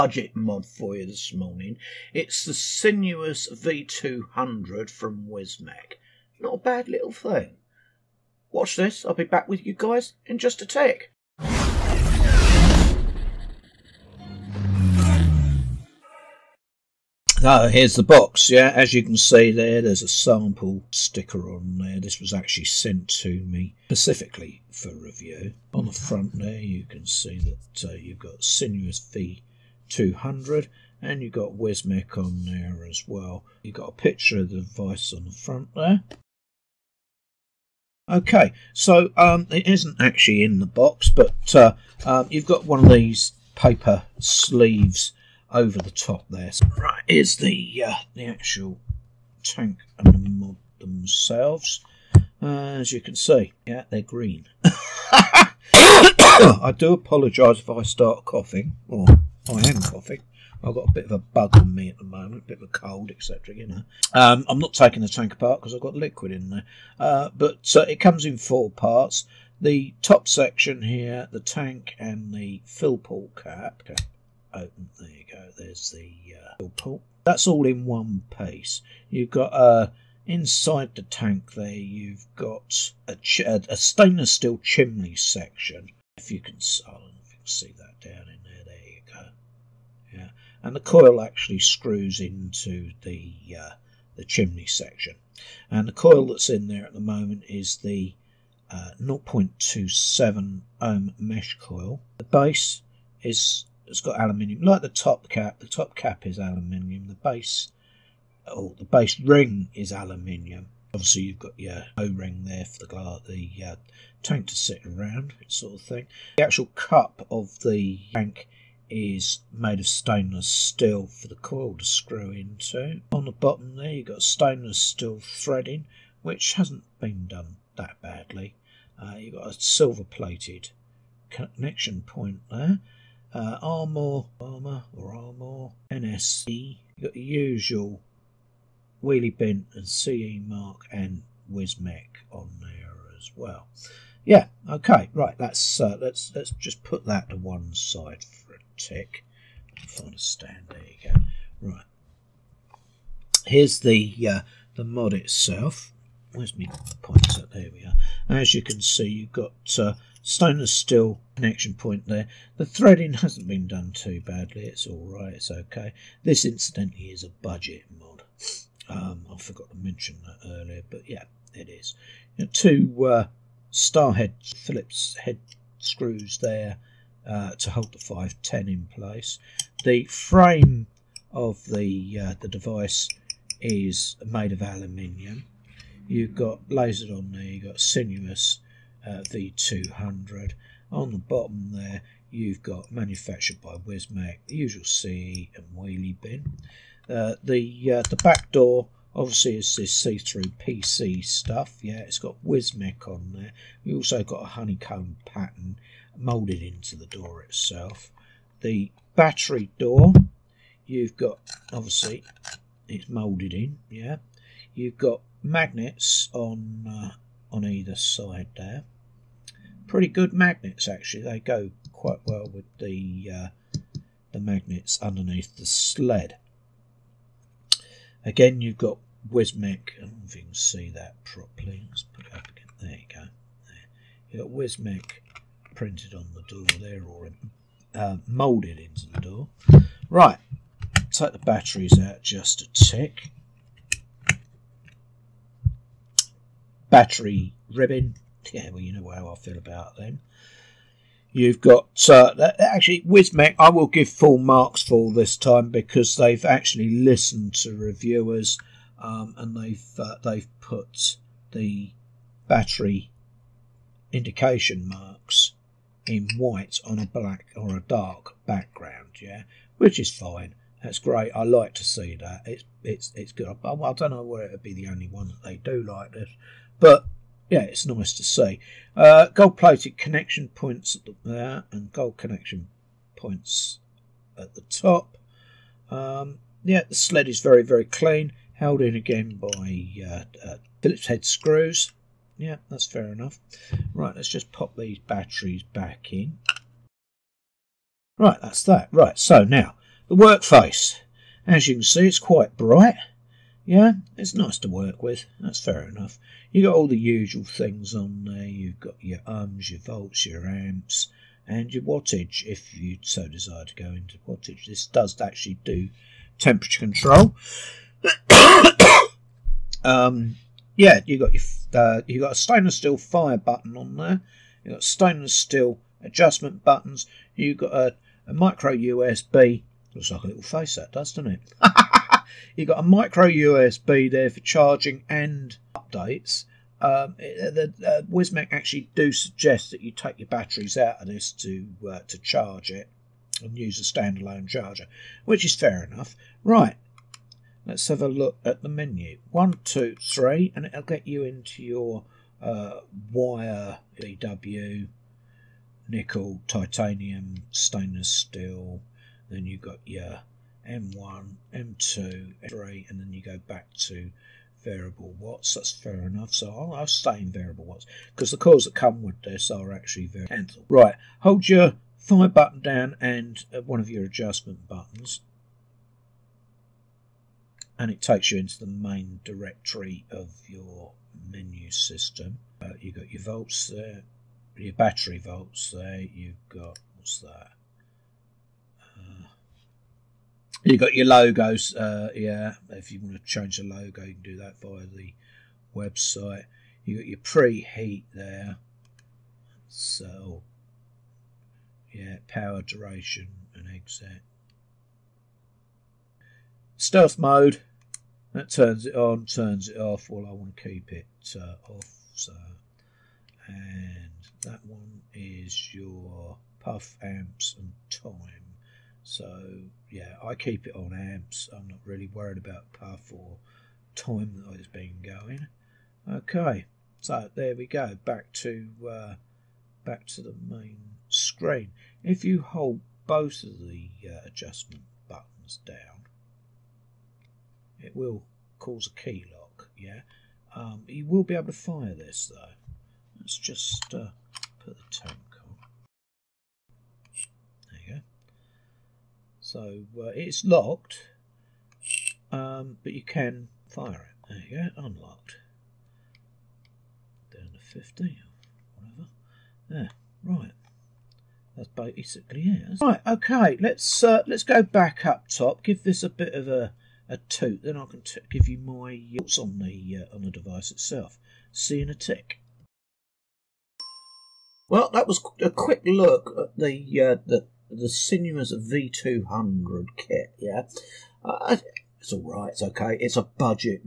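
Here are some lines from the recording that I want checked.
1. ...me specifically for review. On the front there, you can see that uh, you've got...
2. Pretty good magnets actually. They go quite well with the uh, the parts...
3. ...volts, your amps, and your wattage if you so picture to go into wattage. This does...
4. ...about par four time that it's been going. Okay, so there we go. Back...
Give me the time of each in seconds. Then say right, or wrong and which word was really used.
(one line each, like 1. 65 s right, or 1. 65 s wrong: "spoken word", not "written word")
1. 23 s right
2. 219 s wrong: "magnets", not "parts"
3. 309 s wrong: "desire", not "picture"
4. 422 s right.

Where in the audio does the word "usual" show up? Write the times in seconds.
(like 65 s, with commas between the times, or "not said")
137 s, 194 s, 306 s.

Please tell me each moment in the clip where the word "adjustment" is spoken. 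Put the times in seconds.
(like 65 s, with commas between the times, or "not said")
326 s, 374 s, 434 s.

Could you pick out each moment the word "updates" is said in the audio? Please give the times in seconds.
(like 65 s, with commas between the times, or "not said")
335 s.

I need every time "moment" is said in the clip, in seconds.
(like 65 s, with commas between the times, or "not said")
62 s, 96 s.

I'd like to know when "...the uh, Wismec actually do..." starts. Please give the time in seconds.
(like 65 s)
337 s.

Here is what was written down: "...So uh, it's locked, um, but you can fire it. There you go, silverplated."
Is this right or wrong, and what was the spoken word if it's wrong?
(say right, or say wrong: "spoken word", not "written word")
wrong: "unlocked", not "silverplated".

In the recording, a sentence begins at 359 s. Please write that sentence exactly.
Then you've got your M1, M2, M3, and then you go back to variable watts.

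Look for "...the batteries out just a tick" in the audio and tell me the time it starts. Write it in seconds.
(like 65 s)
241 s.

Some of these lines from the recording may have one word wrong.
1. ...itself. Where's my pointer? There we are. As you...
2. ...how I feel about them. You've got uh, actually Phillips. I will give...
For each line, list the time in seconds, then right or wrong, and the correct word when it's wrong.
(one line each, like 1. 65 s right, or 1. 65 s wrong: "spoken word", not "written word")
1. 155 s right
2. 249 s wrong: "Wismec", not "Phillips".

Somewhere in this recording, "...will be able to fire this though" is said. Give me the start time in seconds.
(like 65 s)
441 s.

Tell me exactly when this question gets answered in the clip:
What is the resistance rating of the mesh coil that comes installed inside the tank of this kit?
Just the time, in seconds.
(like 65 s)
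99 s.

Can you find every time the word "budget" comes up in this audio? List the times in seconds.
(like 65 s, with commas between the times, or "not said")
167 s, 483 s.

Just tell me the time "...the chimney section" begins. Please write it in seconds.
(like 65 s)
94 s.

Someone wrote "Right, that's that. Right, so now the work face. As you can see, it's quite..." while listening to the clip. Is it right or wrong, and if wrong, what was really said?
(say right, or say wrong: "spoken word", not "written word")
right.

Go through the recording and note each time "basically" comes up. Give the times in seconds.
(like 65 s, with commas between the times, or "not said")
461 s.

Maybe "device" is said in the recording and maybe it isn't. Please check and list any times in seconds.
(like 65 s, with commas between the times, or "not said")
34 s, 182 s, 470 s.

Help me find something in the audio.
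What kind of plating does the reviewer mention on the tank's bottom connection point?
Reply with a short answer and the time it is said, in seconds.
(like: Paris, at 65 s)
silver-plated, at 129 s.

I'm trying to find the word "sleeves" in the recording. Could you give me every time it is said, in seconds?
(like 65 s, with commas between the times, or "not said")
44 s.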